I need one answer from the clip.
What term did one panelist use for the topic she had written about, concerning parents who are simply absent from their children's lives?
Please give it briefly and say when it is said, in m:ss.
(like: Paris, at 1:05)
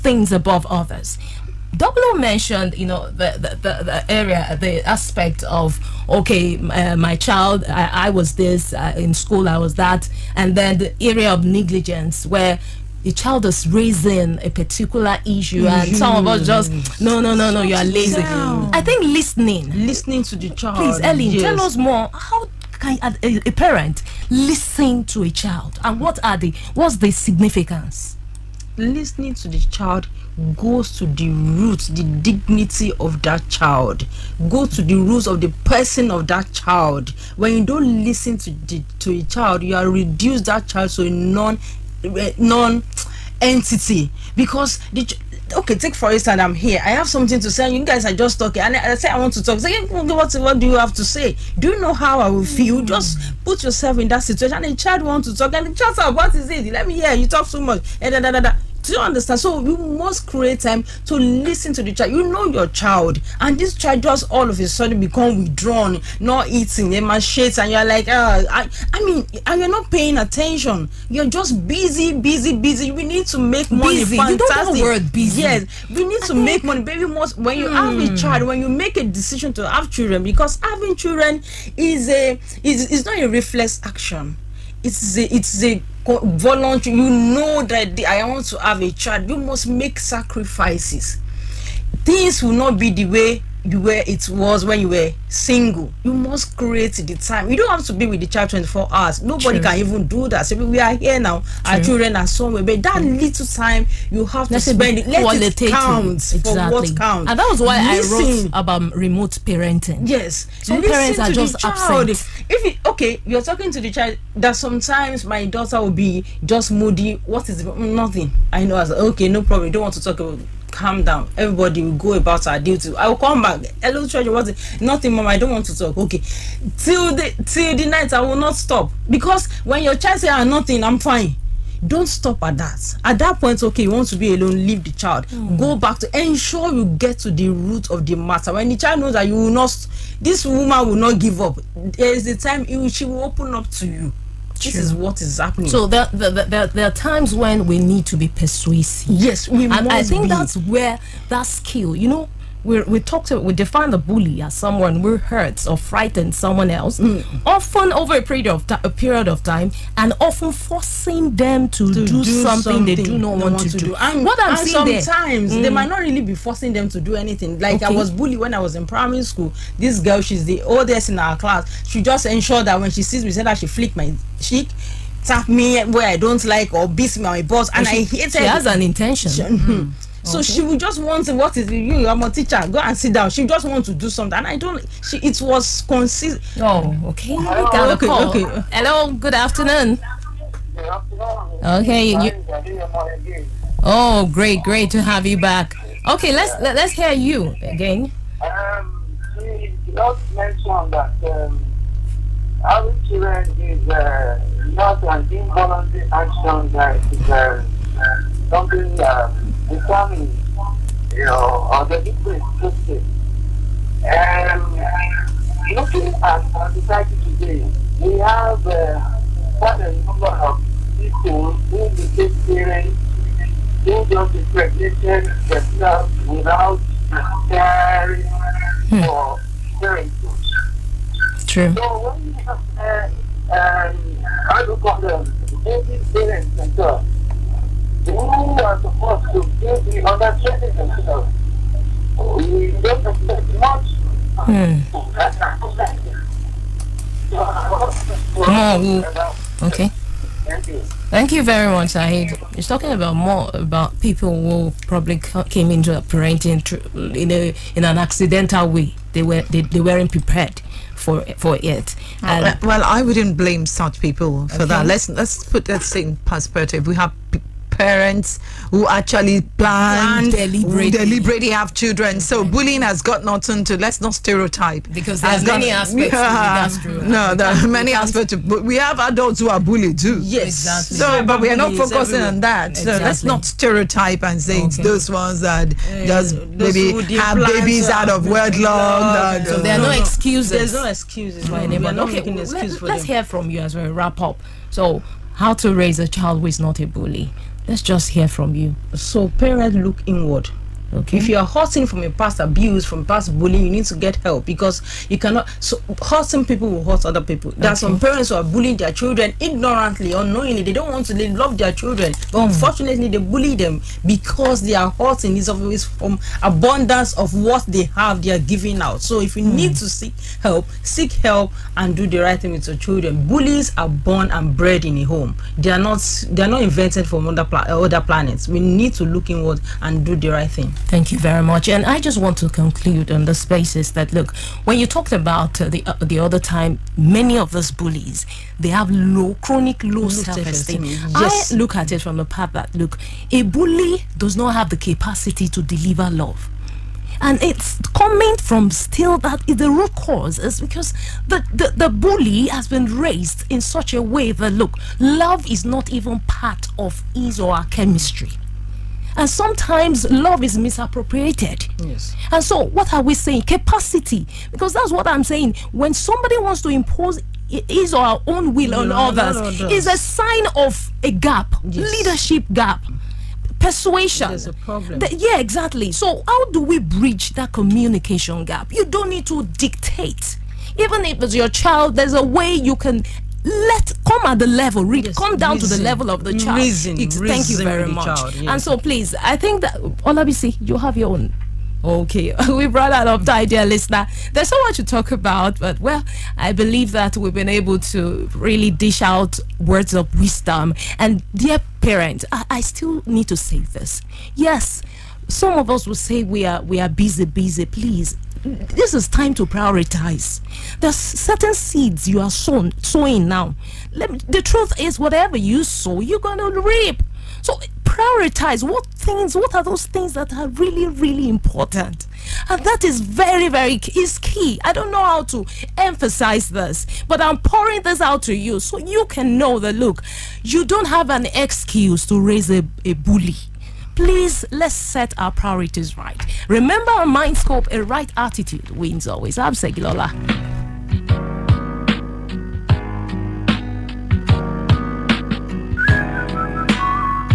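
remote parenting, at 1:48.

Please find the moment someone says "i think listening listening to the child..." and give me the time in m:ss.
0:18.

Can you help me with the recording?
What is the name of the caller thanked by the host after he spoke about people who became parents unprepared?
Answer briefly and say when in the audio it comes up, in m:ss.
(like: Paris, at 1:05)
Saeed, at 4:11.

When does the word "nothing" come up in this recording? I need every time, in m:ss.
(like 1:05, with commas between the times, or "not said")
1:57, 2:04, 2:10, 4:33.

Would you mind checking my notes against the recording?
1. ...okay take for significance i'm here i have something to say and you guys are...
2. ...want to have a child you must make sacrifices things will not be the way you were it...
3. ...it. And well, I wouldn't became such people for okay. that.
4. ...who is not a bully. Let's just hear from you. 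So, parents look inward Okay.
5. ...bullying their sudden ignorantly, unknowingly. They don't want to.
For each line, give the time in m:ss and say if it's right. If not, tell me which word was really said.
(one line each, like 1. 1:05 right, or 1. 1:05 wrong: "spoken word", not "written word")
1. 0:45 wrong: "instance", not "significance"
2. 1:28 right
3. 4:21 wrong: "blame", not "became"
4. 4:56 right
5. 5:08 wrong: "children", not "sudden".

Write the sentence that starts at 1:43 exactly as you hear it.
little time you have to spend it.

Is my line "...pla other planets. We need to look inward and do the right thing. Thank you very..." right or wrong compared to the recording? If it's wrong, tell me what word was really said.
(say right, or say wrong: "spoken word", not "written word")
right.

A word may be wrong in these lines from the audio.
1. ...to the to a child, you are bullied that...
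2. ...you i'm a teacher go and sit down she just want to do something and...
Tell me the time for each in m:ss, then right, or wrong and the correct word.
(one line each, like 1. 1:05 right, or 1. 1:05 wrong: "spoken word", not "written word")
1. 0:38 wrong: "reduced", not "bullied"
2. 3:01 right.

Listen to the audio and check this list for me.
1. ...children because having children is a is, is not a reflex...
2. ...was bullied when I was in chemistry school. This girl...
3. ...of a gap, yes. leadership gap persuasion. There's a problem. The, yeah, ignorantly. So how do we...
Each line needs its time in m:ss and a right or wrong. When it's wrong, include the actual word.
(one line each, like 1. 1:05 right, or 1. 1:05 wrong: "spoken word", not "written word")
1. 1:19 right
2. 2:47 wrong: "primary", not "chemistry"
3. 6:10 wrong: "exactly", not "ignorantly".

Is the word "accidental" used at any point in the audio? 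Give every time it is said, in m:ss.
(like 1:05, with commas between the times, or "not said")
4:17.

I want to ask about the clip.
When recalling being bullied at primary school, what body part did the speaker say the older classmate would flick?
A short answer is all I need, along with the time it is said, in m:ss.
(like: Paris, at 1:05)
cheek, at 2:54.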